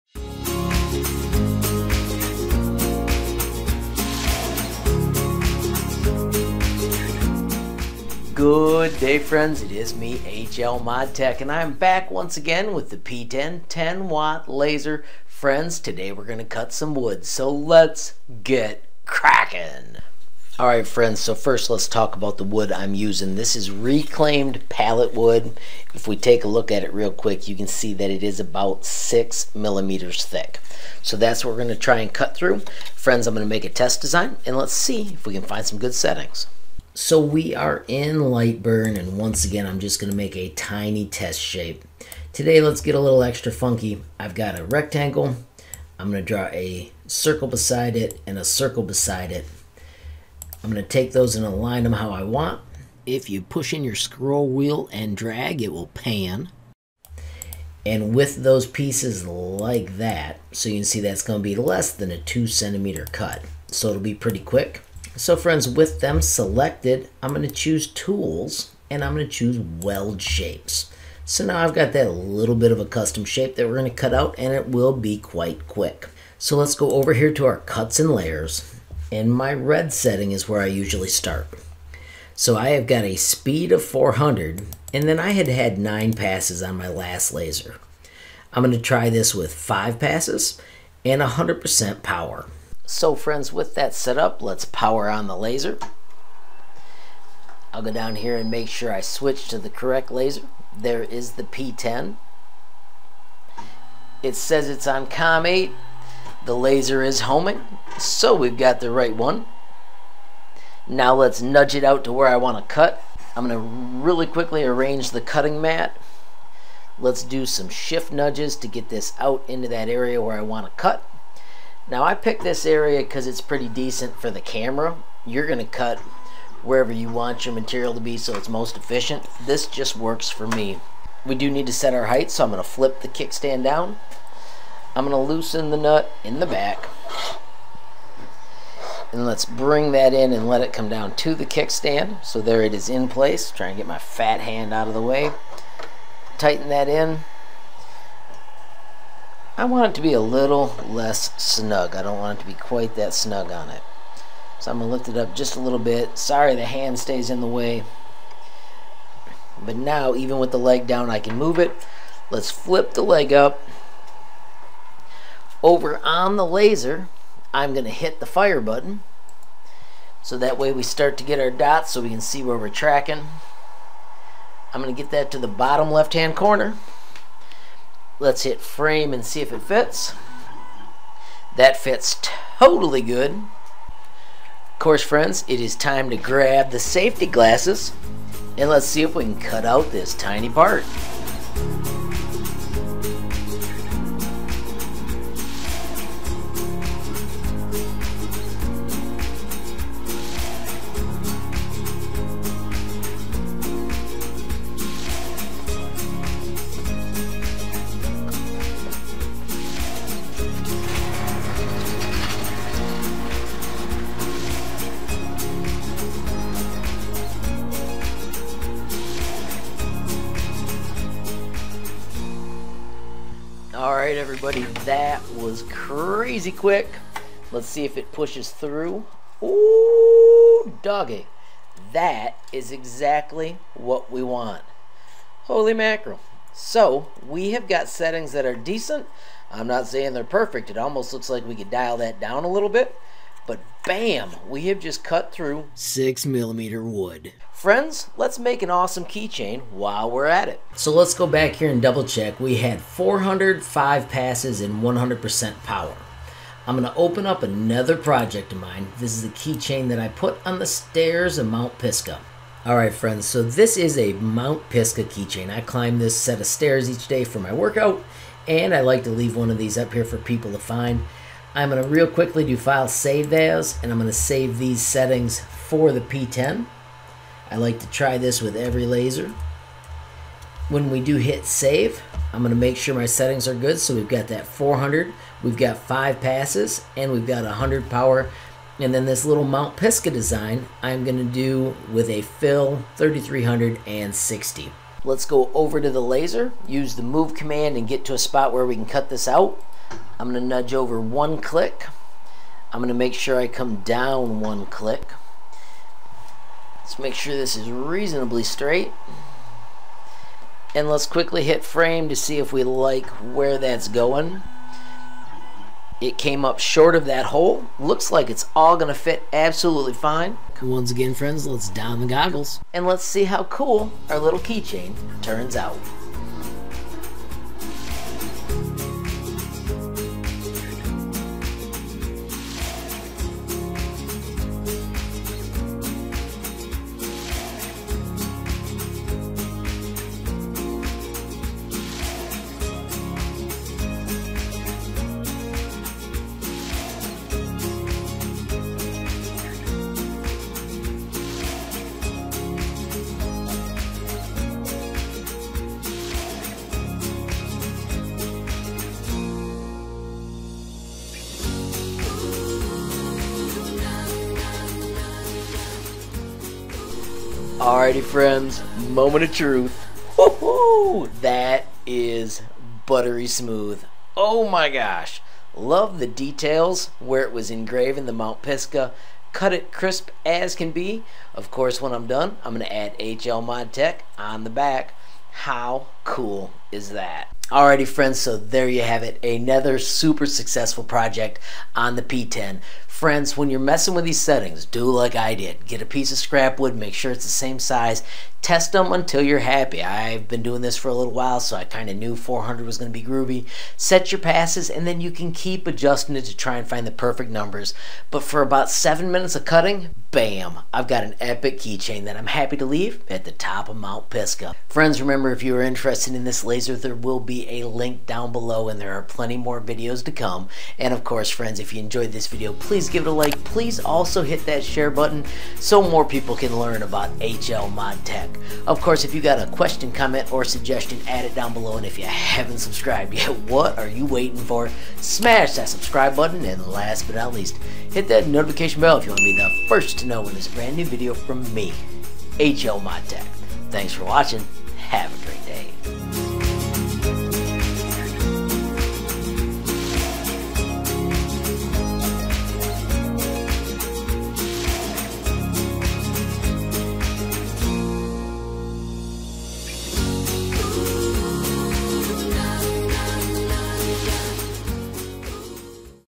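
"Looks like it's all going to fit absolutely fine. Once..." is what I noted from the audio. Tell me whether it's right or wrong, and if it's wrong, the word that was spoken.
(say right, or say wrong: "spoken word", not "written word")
right.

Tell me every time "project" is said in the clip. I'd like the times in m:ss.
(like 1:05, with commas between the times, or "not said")
4:17, 6:30.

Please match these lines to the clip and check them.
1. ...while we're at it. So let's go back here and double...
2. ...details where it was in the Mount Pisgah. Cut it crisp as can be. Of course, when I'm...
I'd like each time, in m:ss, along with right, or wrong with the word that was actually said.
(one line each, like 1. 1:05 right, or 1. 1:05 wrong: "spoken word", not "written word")
1. 4:09 right
2. 6:16 right.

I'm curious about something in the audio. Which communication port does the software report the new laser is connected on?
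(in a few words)
COM8.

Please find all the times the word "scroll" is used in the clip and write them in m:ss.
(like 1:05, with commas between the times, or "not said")
0:53.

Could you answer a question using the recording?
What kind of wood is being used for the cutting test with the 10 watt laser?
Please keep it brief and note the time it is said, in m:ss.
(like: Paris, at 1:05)
Reclaimed pallet wood, at 0:23.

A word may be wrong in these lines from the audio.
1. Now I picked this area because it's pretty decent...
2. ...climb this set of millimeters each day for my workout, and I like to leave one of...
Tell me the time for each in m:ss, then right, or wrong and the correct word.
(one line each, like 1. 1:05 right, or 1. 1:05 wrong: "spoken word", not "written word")
1. 2:01 right
2. 4:25 wrong: "stairs", not "millimeters".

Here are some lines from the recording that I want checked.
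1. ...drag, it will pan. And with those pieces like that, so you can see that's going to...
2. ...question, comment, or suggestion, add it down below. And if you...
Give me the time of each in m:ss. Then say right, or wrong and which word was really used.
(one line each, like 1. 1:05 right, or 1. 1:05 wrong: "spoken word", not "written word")
1. 0:55 right
2. 7:09 right.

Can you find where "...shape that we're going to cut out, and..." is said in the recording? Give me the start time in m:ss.
1:13.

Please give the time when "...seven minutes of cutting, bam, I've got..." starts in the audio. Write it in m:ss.
6:48.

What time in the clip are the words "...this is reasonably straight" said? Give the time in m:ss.
5:07.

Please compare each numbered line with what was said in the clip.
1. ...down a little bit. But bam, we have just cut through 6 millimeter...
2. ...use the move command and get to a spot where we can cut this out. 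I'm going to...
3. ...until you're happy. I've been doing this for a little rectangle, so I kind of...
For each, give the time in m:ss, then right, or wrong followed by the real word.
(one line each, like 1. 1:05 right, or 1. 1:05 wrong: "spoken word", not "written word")
1. 4:02 right
2. 4:56 right
3. 6:38 wrong: "while", not "rectangle".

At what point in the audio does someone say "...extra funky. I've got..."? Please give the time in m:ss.
0:43.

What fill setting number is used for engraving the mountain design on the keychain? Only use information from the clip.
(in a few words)
3360.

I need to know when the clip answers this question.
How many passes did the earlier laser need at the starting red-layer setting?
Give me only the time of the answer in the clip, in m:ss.
1:25.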